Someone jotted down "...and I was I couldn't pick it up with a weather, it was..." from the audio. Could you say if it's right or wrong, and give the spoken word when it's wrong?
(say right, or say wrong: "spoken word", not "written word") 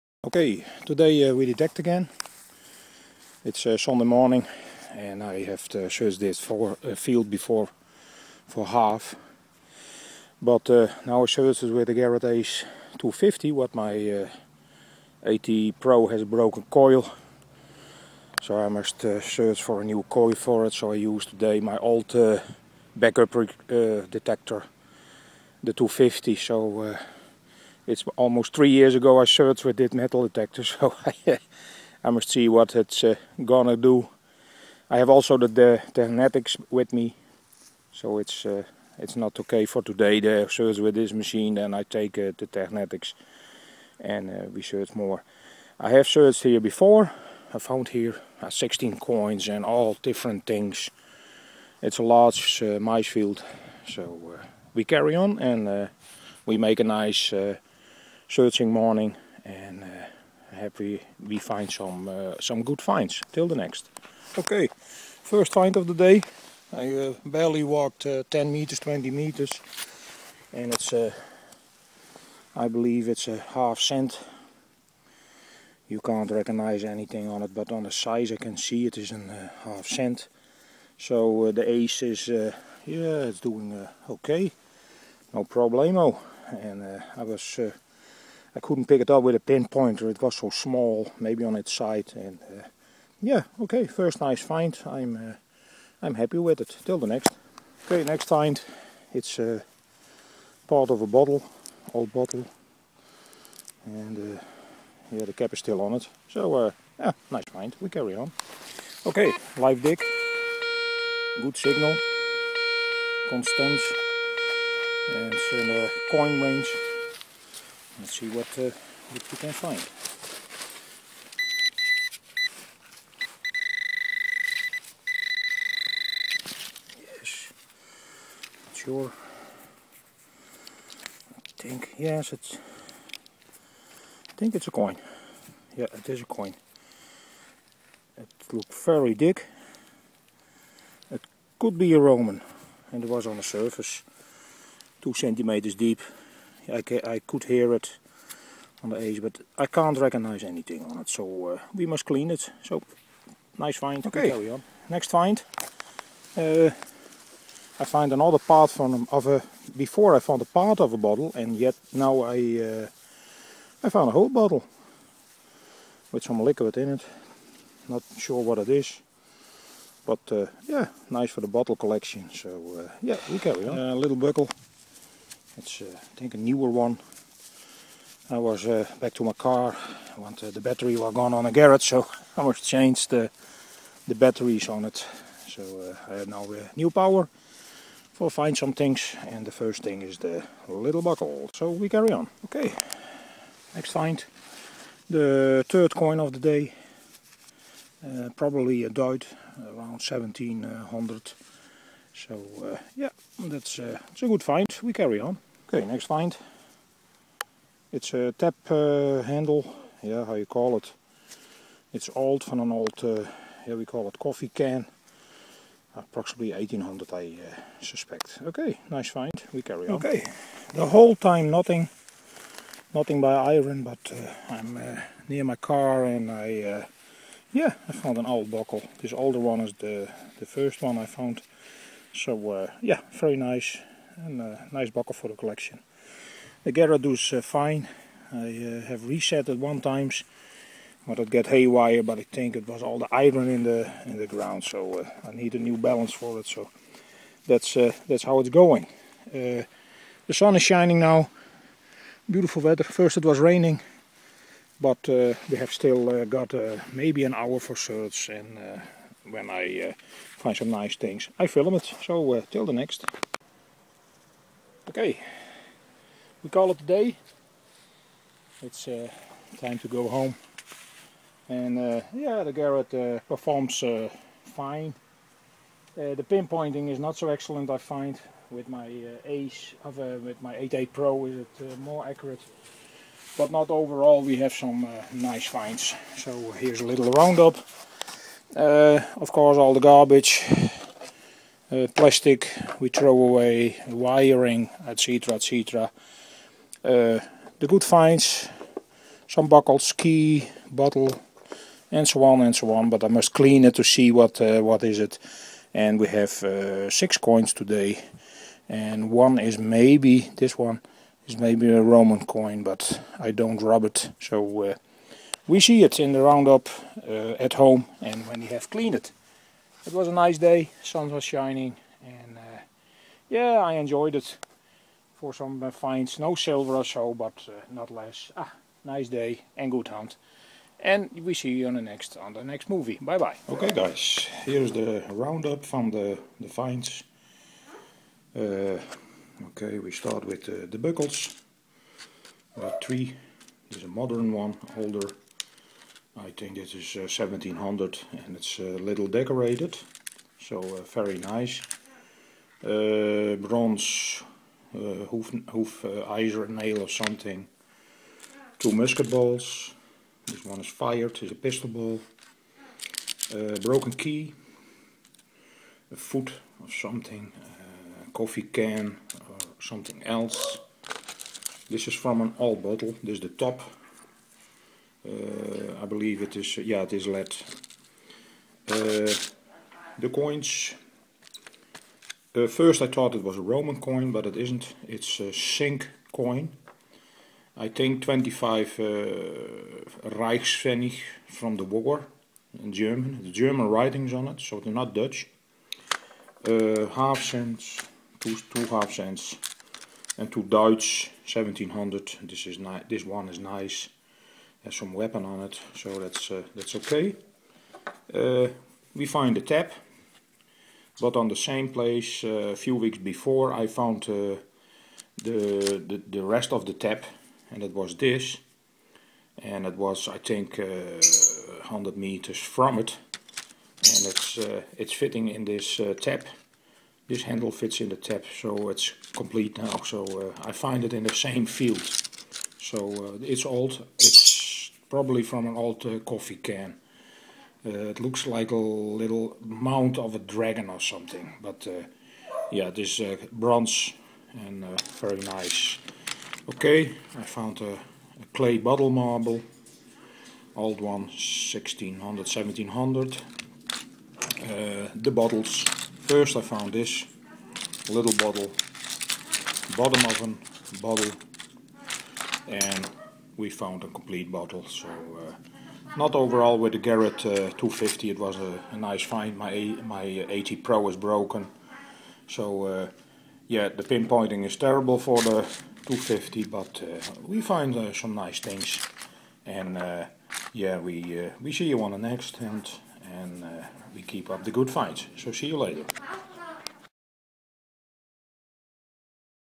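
wrong: "pinpointer", not "weather".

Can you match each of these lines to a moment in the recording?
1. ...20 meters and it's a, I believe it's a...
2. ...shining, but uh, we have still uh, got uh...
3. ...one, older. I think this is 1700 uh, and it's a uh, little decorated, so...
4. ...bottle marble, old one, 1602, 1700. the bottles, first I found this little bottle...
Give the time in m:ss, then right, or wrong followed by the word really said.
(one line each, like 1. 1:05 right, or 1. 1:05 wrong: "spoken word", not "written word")
1. 1:08 right
2. 4:13 wrong: "raining", not "shining"
3. 5:44 right
4. 7:28 wrong: "1600", not "1602".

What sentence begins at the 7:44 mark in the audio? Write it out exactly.
So uh, not overall with the Garrett uh, 250, it was a, a, nice find.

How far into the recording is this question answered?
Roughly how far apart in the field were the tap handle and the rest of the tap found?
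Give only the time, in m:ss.
7:00.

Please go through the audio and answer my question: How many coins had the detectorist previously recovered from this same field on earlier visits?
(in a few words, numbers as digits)
16.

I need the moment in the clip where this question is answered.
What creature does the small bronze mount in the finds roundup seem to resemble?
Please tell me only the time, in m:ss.
7:20.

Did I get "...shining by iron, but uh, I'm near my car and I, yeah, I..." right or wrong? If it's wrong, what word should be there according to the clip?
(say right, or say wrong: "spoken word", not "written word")
wrong: "nothing", not "shining".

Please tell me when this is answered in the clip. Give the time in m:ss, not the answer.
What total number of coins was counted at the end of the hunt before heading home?
5:06.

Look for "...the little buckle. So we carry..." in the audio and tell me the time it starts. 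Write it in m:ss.
3:10.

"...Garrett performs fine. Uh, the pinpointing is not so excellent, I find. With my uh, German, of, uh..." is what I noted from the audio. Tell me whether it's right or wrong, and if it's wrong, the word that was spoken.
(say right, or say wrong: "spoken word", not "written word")
wrong: "Ace", not "German".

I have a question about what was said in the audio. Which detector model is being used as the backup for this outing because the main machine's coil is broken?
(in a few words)
Garrett Ace 250.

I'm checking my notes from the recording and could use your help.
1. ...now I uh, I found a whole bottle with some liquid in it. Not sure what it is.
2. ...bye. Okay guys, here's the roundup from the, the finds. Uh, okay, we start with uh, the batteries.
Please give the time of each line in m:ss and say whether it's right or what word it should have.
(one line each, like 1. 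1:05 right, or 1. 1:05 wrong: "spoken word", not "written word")
1. 2:41 right
2. 5:33 wrong: "buckles", not "batteries".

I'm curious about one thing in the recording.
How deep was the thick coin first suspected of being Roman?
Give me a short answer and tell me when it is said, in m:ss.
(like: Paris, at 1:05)
2 centimeters, at 2:25.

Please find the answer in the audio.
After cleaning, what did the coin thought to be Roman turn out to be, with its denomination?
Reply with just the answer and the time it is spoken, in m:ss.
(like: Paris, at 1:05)
25 Reichspfennig, at 6:28.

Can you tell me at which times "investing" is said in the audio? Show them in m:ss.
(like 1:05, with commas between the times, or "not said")
not said.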